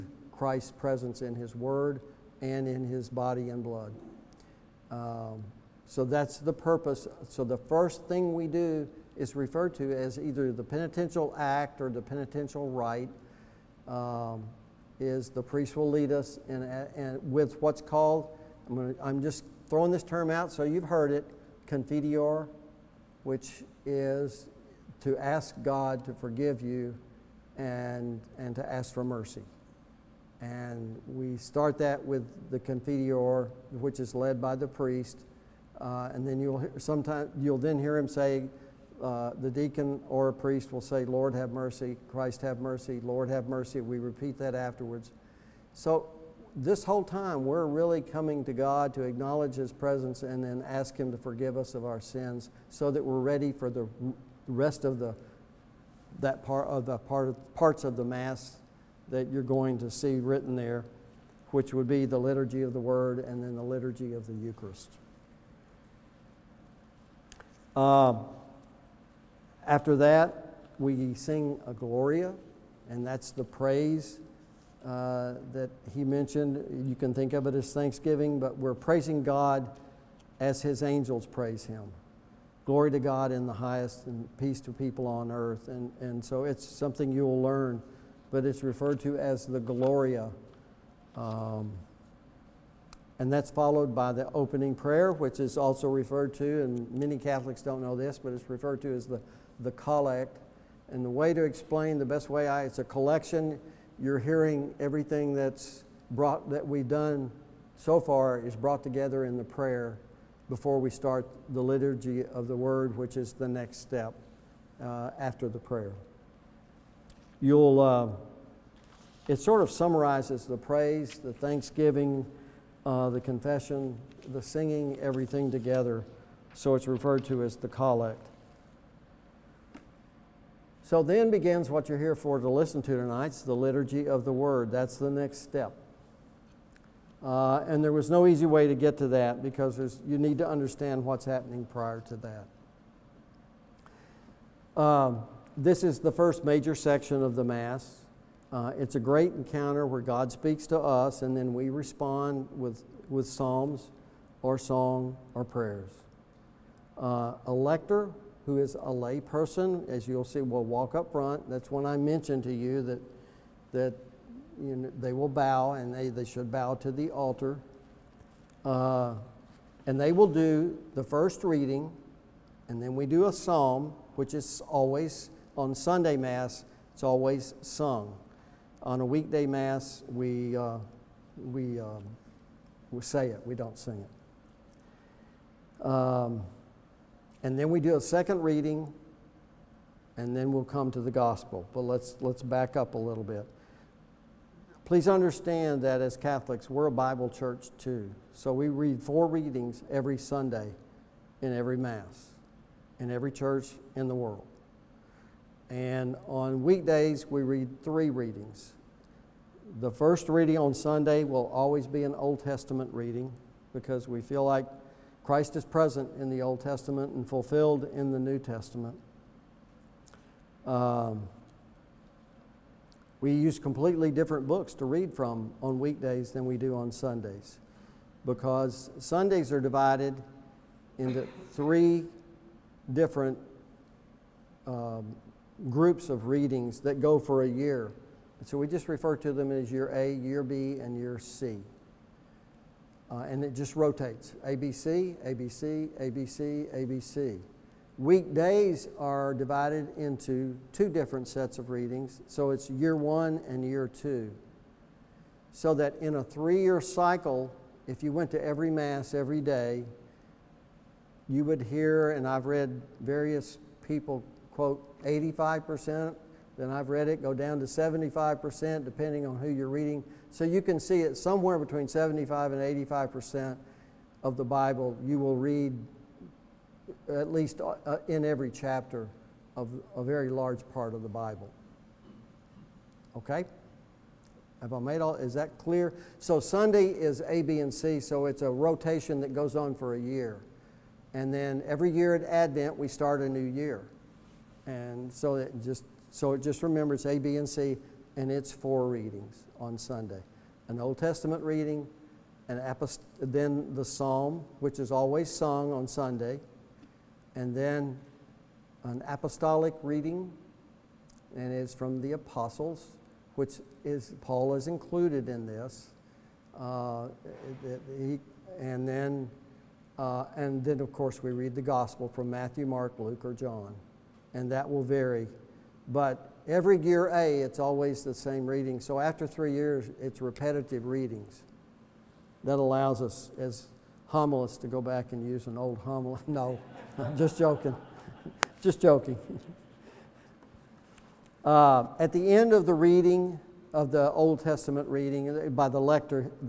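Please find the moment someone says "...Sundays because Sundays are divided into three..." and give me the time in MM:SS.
03:46.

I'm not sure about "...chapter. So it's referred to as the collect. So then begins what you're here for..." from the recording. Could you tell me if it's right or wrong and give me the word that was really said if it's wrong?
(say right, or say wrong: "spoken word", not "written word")
wrong: "together", not "chapter".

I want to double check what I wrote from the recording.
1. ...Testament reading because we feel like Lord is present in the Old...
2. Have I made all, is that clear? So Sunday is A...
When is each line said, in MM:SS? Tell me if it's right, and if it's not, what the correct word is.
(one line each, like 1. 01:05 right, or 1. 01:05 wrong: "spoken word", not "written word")
1. 03:32 wrong: "Christ", not "Lord"
2. 04:44 right.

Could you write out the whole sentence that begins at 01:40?
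And the way to explain, the best way I, it's a collection.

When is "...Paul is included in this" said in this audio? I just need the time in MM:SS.
05:14.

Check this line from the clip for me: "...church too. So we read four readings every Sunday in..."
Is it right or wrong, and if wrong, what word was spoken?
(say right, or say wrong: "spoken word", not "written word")
right.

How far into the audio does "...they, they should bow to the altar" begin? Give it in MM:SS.
02:45.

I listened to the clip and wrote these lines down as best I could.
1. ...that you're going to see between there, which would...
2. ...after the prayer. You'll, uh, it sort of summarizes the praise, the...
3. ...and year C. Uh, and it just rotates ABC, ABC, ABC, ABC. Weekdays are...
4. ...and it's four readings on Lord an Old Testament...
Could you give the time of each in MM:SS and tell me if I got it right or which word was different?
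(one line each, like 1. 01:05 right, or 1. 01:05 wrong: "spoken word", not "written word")
1. 00:59 wrong: "written", not "between"
2. 01:55 right
3. 04:00 right
4. 04:58 wrong: "Sunday", not "Lord".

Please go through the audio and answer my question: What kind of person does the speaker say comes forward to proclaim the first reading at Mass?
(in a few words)
a lay person.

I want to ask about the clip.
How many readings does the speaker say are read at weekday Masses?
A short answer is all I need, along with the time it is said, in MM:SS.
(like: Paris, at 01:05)
3, at 03:27.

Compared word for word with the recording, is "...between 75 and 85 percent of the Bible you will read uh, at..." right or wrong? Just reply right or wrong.
right.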